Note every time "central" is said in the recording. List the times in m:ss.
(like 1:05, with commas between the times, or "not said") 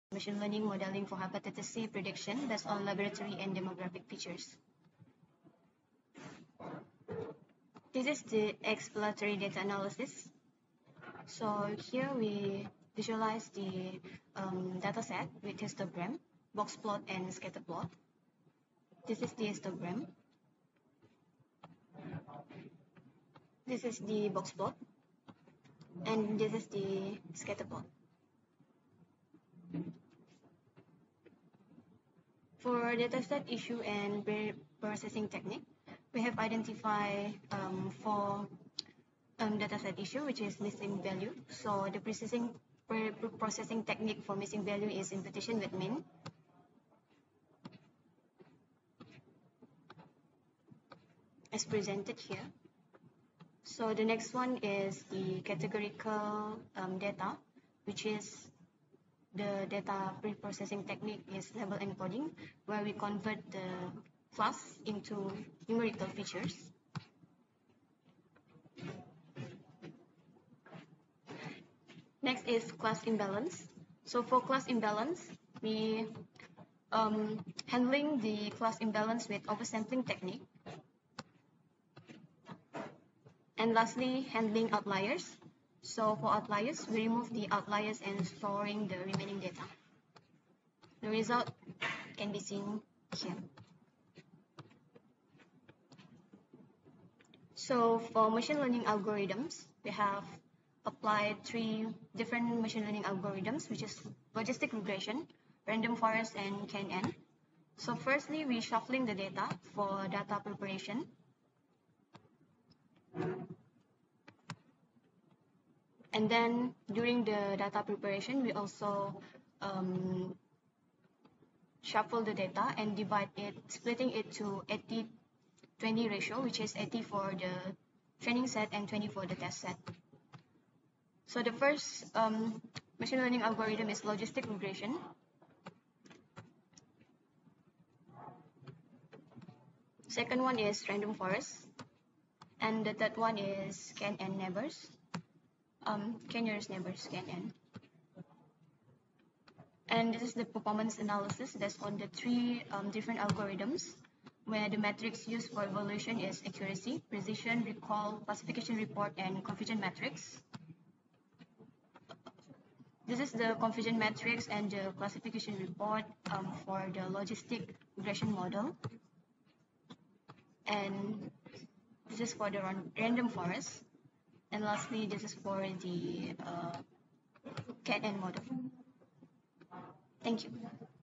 not said.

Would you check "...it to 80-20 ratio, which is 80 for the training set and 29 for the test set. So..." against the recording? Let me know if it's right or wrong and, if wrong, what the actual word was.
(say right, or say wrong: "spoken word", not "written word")
wrong: "20", not "29".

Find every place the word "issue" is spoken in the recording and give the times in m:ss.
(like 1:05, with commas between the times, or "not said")
0:33, 0:39.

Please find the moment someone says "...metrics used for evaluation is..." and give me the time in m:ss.
2:34.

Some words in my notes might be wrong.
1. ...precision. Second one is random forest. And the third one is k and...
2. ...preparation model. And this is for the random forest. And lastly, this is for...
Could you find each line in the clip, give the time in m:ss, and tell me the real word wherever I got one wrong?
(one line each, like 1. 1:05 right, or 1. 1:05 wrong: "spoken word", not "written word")
1. 2:14 wrong: "regression", not "precision"
2. 2:47 wrong: "regression", not "preparation".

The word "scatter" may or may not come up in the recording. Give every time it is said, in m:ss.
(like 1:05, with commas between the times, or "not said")
0:17, 0:27.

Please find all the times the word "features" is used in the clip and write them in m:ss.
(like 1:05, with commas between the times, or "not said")
0:04, 1:06.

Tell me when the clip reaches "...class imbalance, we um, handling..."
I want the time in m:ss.
1:14.